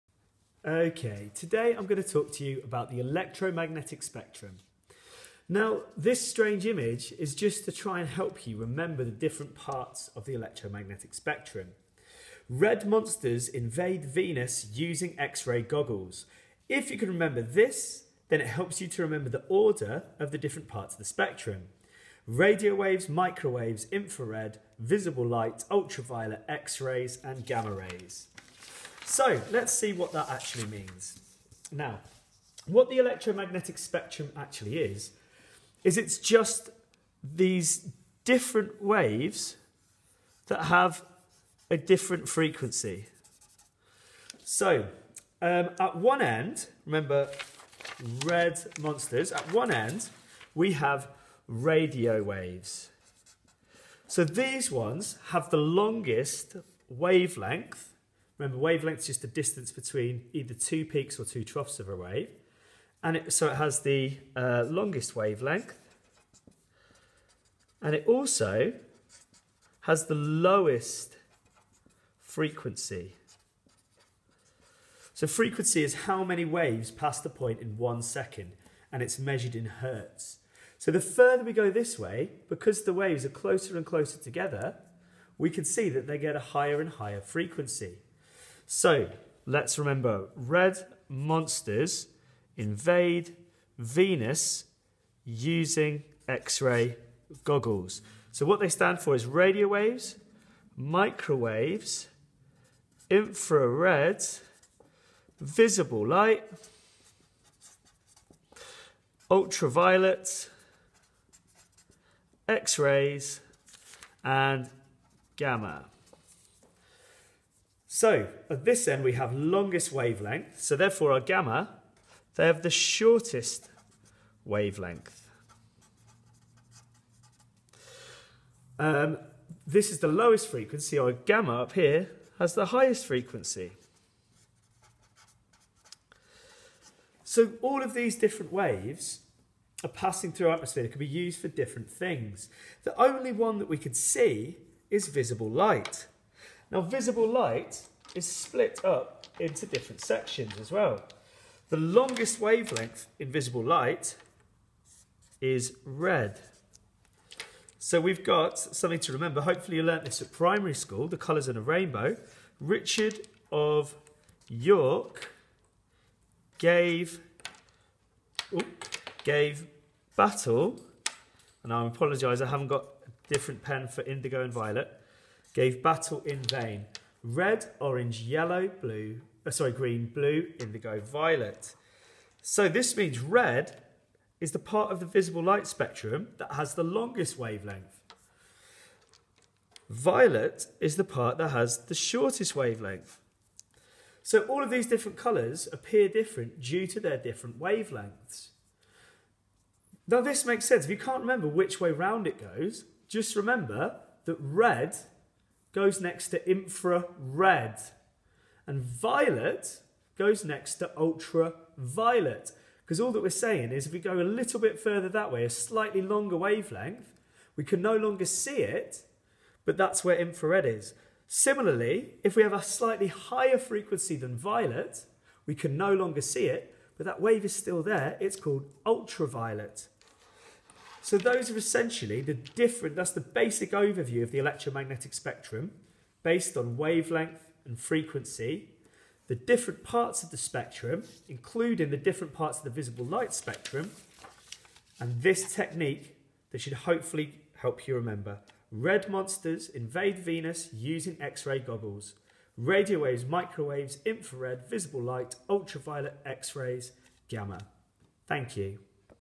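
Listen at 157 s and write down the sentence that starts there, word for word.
So we've got something to remember.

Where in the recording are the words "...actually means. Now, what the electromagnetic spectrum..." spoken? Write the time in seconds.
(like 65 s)
30 s.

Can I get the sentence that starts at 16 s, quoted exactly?
If you can remember this, then it helps you to remember the order of the different parts of the spectrum.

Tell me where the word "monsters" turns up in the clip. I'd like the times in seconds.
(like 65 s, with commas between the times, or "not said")
12 s, 48 s, 91 s, 249 s.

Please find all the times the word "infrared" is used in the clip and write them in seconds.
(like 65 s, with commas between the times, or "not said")
23 s, 103 s, 206 s, 220 s, 254 s.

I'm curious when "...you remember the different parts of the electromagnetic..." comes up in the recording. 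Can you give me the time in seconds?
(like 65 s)
8 s.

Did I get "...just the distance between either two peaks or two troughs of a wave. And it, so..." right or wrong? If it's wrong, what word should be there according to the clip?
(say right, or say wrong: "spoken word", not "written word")
right.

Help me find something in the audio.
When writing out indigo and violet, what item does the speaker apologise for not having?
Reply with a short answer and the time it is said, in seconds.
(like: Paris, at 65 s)
a different pen, at 173 s.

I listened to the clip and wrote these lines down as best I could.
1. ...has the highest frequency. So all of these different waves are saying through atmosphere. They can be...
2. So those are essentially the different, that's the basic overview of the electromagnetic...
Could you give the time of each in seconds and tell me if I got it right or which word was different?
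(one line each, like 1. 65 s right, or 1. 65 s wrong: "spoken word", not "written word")
1. 132 s wrong: "passing", not "saying"
2. 231 s right.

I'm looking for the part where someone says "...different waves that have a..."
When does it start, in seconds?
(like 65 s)
38 s.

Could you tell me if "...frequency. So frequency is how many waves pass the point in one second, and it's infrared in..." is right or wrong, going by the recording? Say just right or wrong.
wrong.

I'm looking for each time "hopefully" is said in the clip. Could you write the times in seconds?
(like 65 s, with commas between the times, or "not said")
159 s, 246 s.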